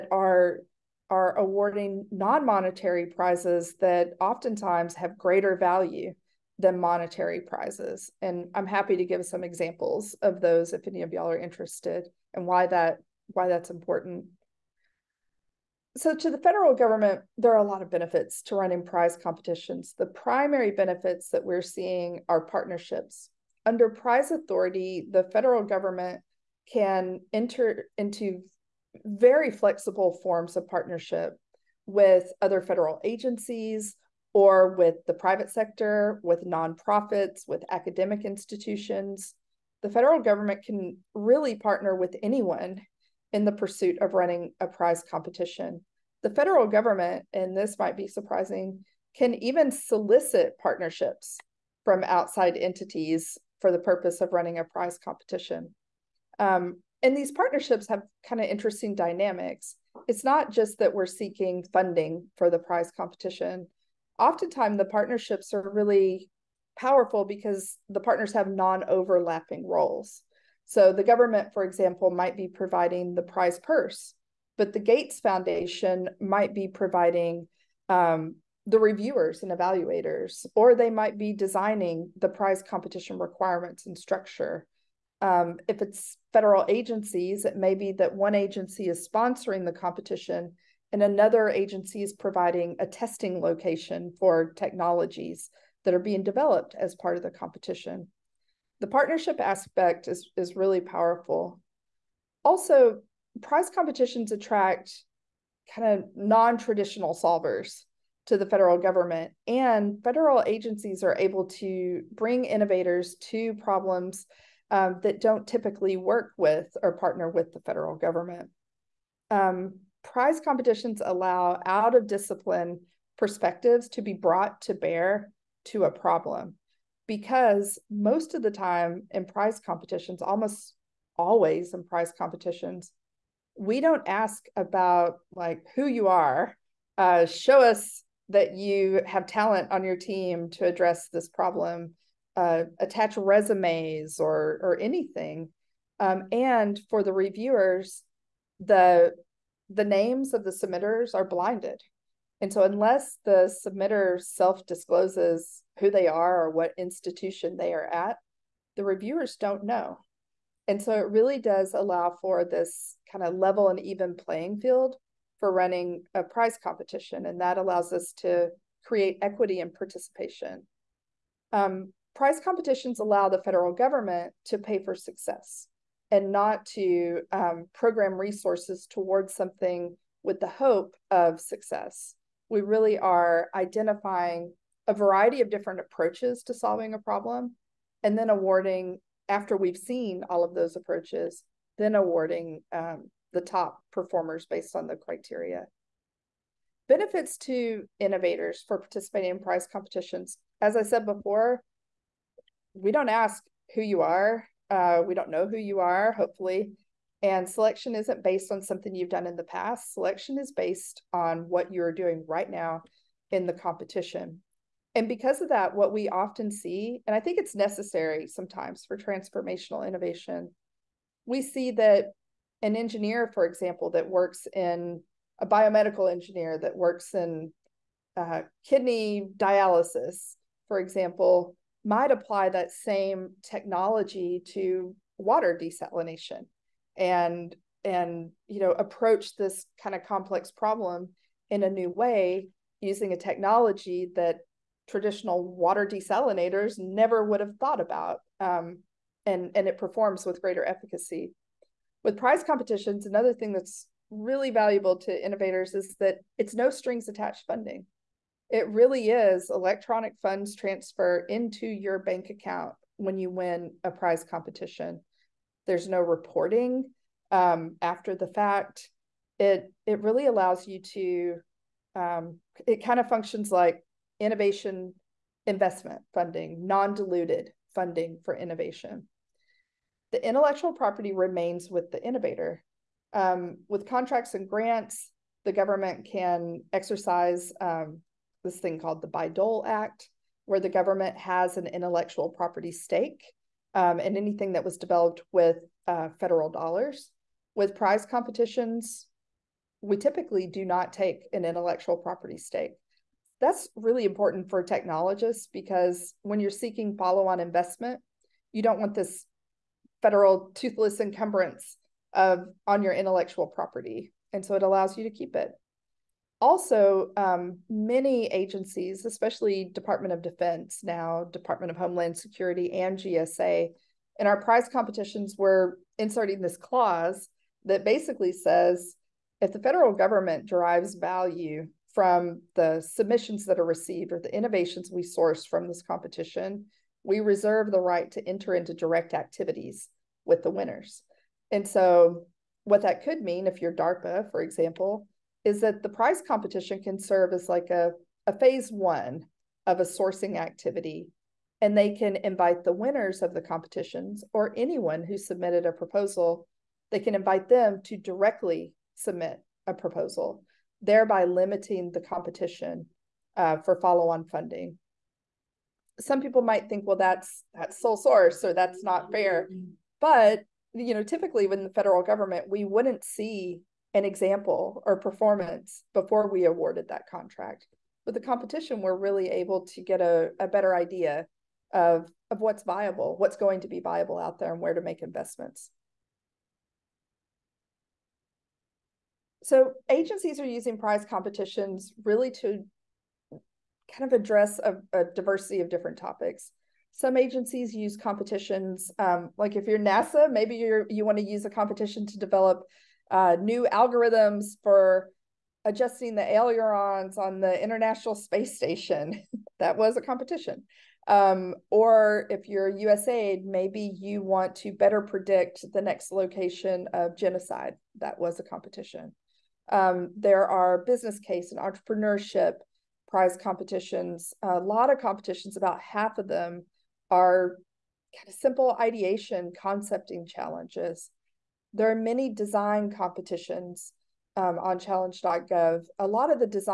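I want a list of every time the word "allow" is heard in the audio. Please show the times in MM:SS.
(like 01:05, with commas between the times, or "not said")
02:01, 02:41, 02:47, 02:52, 04:30, 05:14.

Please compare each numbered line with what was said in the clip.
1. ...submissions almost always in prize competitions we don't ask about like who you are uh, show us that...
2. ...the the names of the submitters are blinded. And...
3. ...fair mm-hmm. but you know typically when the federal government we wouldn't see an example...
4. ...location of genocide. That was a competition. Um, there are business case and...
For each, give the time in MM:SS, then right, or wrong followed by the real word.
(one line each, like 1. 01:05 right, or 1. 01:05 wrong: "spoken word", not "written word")
1. 02:09 wrong: "competitions", not "submissions"
2. 02:28 right
3. 06:09 right
4. 06:56 right.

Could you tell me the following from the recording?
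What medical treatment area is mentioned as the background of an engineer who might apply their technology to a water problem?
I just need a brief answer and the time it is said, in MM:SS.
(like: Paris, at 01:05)
kidney dialysis, at 03:48.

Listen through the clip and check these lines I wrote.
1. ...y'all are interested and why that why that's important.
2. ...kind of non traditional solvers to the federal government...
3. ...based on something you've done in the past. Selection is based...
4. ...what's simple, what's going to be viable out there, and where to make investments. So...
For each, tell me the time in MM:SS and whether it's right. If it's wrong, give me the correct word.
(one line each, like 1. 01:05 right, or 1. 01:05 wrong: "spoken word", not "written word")
1. 00:11 right
2. 01:45 right
3. 03:28 right
4. 06:22 wrong: "viable", not "simple".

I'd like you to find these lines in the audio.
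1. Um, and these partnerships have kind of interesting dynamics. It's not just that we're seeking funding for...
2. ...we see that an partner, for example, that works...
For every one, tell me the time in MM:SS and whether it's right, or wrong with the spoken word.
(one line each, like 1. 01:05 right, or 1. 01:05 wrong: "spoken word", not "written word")
1. 00:56 right
2. 03:41 wrong: "engineer", not "partner".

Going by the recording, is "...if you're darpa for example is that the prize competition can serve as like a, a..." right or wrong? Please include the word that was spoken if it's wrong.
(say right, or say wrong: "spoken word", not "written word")
right.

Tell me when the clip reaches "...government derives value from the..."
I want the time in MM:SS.
05:29.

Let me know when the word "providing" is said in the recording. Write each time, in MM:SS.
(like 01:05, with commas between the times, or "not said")
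01:12, 01:16, 01:32.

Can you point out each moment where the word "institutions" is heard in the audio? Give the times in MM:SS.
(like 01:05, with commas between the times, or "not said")
00:38, 02:36.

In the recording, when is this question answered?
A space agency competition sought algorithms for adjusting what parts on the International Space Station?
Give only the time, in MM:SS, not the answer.
06:46.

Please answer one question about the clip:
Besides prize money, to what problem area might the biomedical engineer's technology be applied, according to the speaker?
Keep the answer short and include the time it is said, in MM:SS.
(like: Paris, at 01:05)
water desalination, at 03:55.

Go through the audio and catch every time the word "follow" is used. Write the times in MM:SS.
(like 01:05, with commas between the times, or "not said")
05:06, 06:03.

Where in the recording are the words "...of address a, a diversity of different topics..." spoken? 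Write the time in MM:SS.
06:34.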